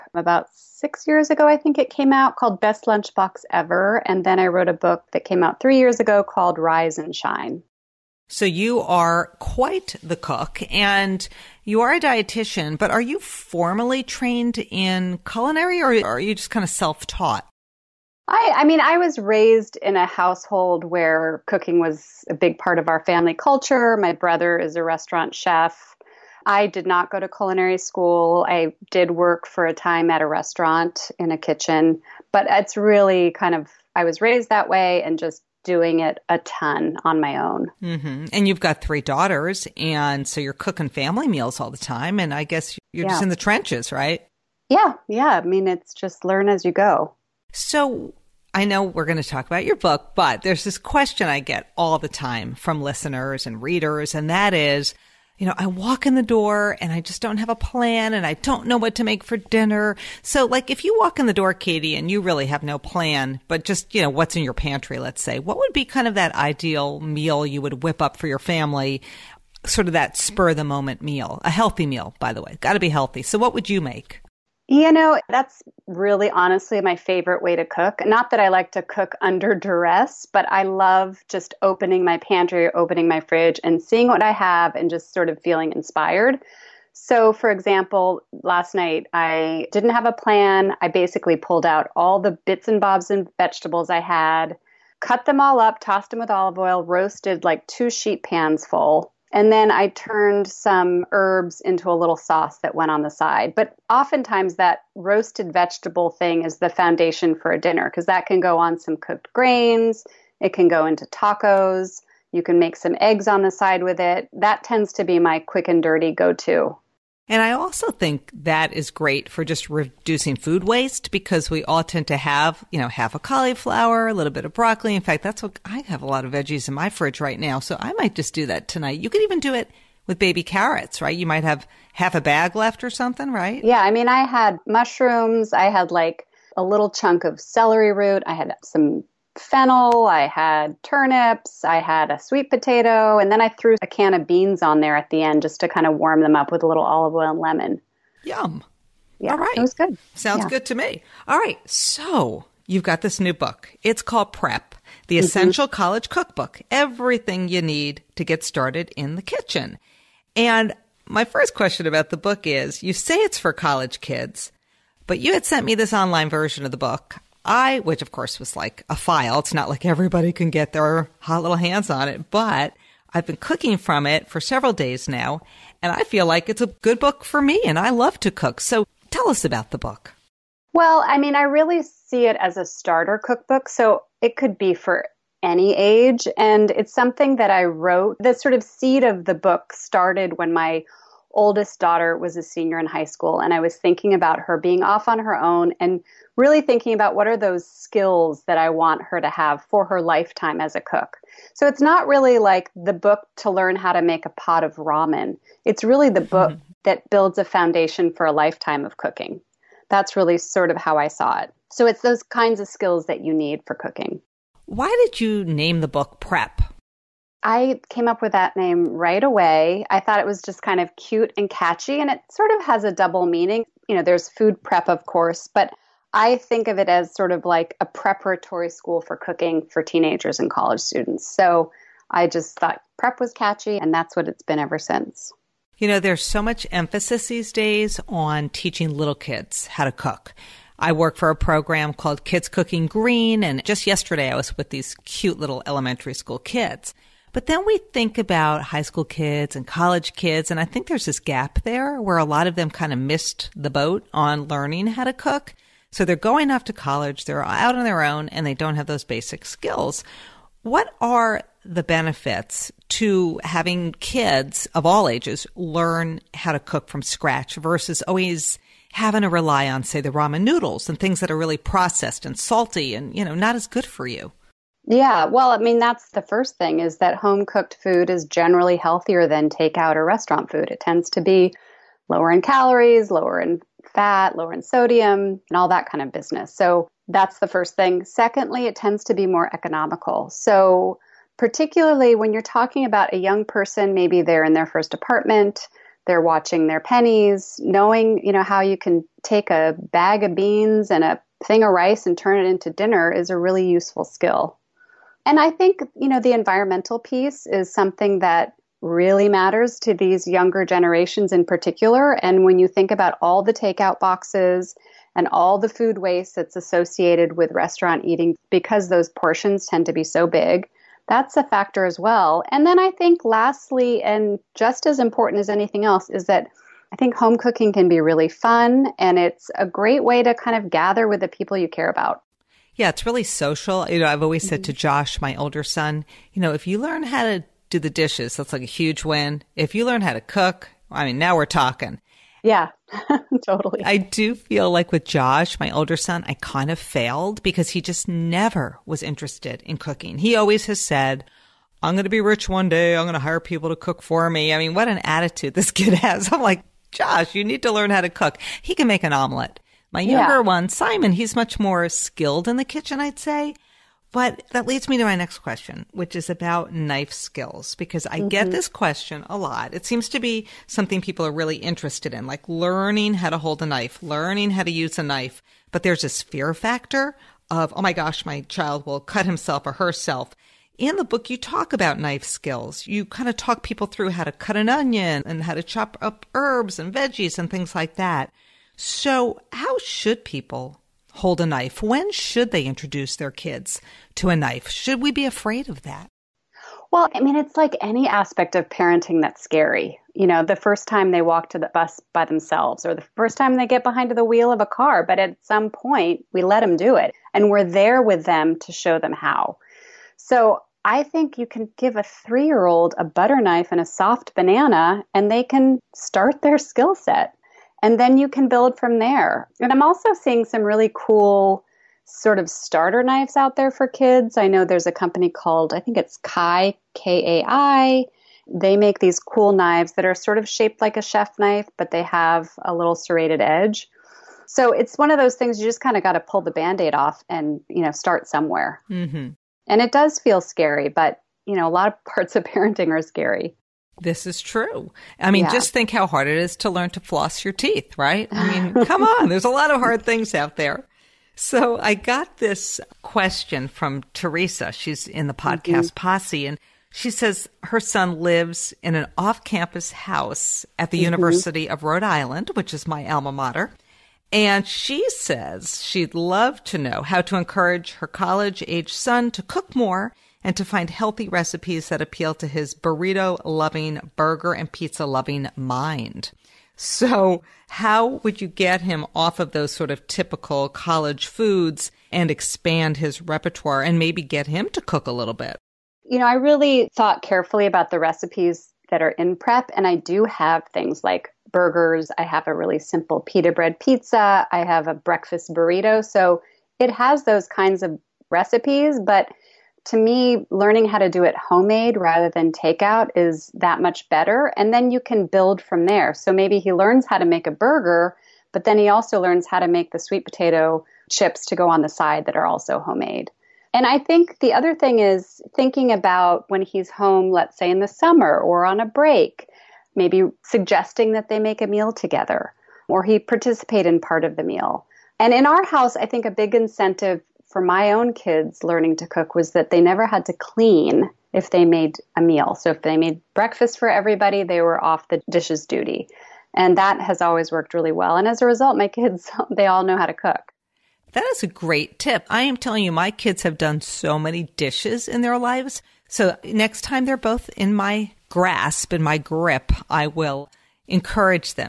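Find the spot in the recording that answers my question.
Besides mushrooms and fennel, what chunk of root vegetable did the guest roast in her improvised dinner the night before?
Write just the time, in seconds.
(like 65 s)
137 s.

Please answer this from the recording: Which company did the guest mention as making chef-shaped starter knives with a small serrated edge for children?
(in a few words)
Kai.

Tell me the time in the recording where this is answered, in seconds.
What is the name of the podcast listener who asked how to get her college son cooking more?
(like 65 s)
454 s.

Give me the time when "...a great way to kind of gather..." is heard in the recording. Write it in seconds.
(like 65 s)
329 s.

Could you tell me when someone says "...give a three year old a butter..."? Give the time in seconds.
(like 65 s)
411 s.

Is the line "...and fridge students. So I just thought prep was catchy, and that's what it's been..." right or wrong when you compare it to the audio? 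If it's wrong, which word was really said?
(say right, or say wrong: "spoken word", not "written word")
wrong: "college", not "fridge".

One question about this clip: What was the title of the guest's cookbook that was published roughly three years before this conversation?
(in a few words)
Rise and Shine.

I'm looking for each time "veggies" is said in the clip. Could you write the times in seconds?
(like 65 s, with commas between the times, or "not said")
126 s, 386 s.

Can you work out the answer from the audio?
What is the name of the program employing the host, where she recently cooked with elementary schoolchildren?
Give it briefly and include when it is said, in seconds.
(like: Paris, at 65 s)
Kids Cooking Green, at 242 s.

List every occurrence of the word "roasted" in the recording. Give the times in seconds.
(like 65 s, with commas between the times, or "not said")
96 s, 104 s.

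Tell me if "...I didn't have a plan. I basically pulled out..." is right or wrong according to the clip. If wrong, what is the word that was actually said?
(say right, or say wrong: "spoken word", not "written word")
right.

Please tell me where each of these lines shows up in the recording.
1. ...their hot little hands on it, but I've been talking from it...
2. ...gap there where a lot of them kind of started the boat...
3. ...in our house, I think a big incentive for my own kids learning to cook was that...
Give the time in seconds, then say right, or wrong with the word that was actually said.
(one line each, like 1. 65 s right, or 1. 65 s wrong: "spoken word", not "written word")
1. 170 s wrong: "cooking", not "talking"
2. 251 s wrong: "missed", not "started"
3. 525 s right.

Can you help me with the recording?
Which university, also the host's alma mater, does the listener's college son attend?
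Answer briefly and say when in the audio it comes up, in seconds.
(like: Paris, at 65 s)
University of Rhode Island, at 461 s.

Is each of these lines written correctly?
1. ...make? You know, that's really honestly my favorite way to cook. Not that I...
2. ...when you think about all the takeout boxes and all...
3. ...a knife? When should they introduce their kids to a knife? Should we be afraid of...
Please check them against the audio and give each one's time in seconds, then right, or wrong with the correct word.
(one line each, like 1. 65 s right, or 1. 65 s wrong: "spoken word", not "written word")
1. 73 s right
2. 312 s right
3. 391 s right.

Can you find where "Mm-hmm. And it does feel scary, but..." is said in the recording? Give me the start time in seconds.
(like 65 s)
438 s.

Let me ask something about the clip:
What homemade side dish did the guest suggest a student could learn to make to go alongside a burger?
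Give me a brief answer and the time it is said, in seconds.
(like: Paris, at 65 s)
sweet potato chips, at 509 s.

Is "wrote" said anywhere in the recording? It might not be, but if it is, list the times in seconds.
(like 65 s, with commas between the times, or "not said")
4 s, 187 s.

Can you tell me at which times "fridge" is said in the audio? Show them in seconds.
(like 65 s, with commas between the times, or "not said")
83 s, 126 s.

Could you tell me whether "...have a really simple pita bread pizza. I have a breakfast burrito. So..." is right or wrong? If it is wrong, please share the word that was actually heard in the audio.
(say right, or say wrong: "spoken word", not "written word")
right.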